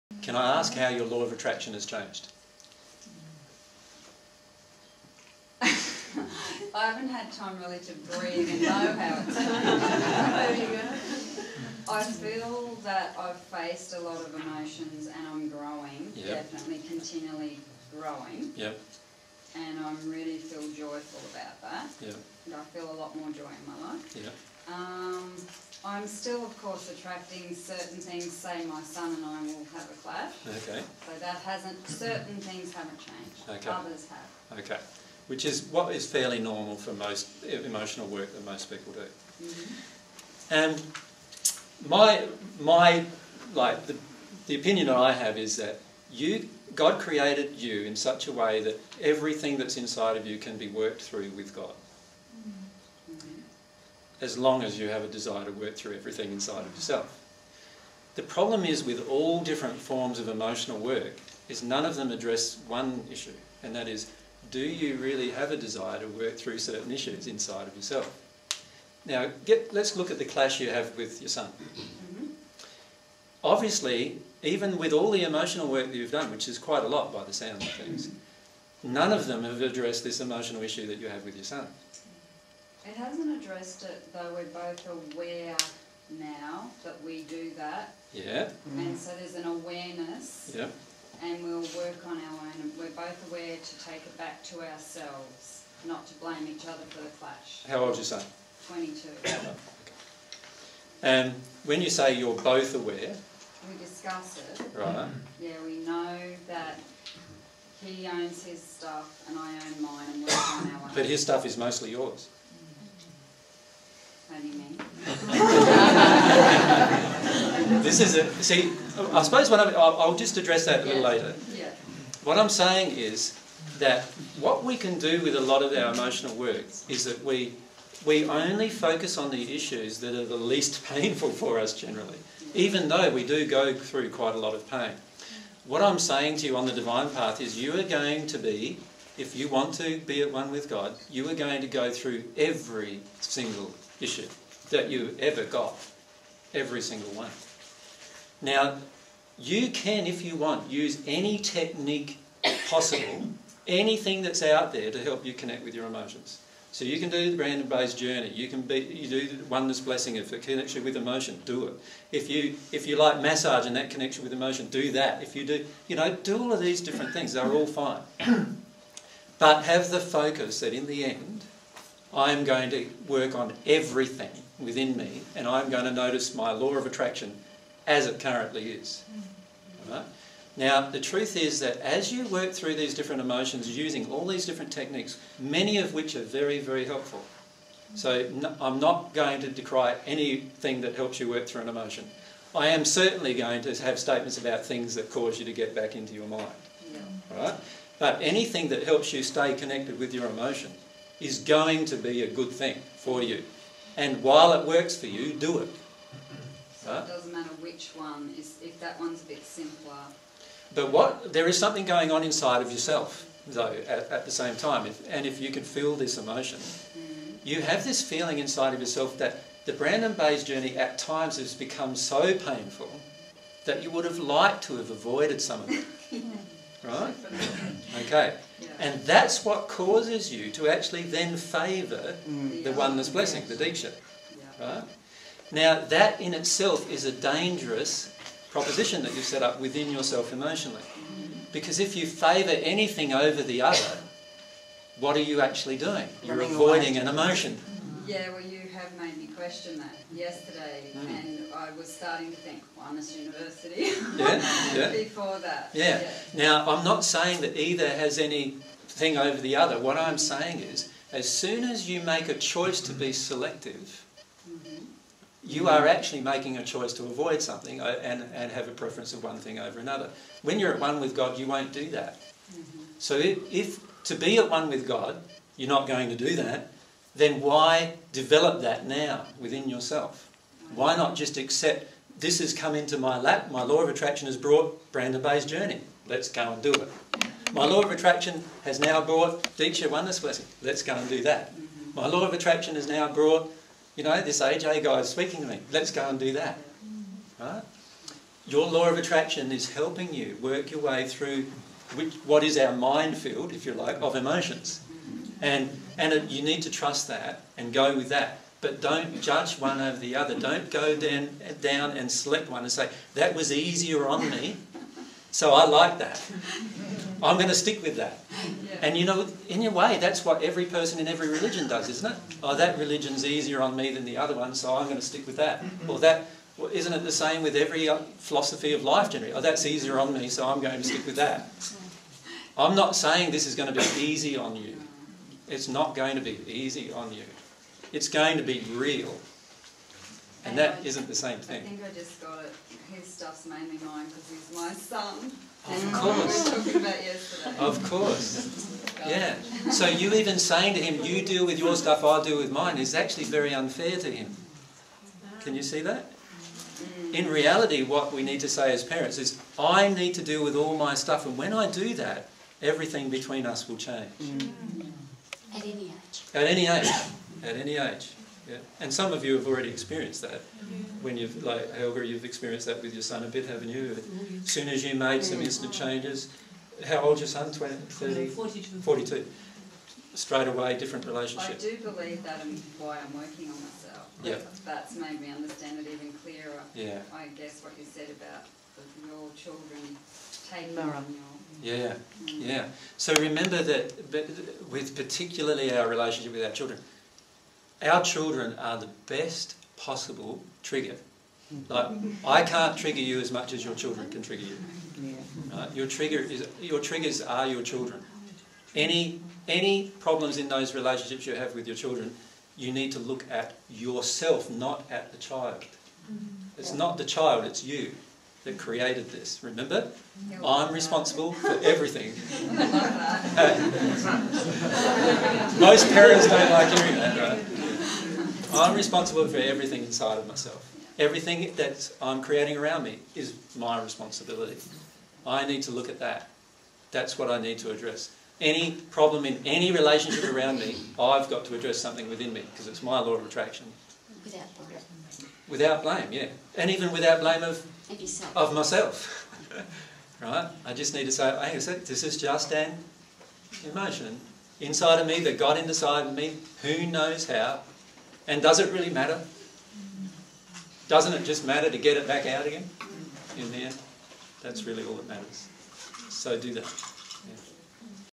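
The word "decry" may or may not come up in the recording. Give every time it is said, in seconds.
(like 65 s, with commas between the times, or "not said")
189 s.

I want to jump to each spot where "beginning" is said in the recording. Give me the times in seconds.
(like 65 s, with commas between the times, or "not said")
not said.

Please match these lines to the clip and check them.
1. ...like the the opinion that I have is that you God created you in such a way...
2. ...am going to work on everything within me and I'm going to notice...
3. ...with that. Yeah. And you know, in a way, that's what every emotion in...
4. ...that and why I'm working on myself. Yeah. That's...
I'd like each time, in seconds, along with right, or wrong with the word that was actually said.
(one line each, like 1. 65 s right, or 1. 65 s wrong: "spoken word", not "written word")
1. 43 s right
2. 172 s right
3. 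317 s wrong: "person", not "emotion"
4. 382 s right.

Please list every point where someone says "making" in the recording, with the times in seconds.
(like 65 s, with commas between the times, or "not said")
266 s.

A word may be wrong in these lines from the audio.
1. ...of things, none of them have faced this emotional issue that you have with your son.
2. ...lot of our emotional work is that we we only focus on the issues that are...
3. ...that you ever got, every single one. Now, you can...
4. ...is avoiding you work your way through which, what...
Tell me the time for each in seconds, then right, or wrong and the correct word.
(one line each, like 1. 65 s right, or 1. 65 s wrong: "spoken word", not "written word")
1. 77 s wrong: "addressed", not "faced"
2. 125 s right
3. 144 s right
4. 299 s wrong: "helping", not "avoiding".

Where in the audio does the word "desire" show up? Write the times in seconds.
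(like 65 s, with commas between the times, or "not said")
55 s, 65 s.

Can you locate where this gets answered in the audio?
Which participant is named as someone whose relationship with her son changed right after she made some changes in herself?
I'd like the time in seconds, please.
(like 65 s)
371 s.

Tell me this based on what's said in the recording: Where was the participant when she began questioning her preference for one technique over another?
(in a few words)
university.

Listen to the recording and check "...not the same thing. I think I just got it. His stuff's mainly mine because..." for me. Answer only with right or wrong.
right.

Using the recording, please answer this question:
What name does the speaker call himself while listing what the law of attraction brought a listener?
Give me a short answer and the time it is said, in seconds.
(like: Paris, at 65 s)
AJ, at 294 s.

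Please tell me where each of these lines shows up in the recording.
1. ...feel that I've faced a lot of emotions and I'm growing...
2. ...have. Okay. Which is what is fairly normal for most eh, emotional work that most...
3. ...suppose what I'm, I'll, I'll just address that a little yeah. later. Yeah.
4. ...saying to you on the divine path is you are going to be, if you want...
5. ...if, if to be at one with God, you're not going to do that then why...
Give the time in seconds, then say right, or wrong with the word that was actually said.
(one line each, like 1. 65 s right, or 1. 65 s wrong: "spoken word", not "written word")
1. 12 s right
2. 34 s right
3. 119 s right
4. 135 s right
5. 273 s right.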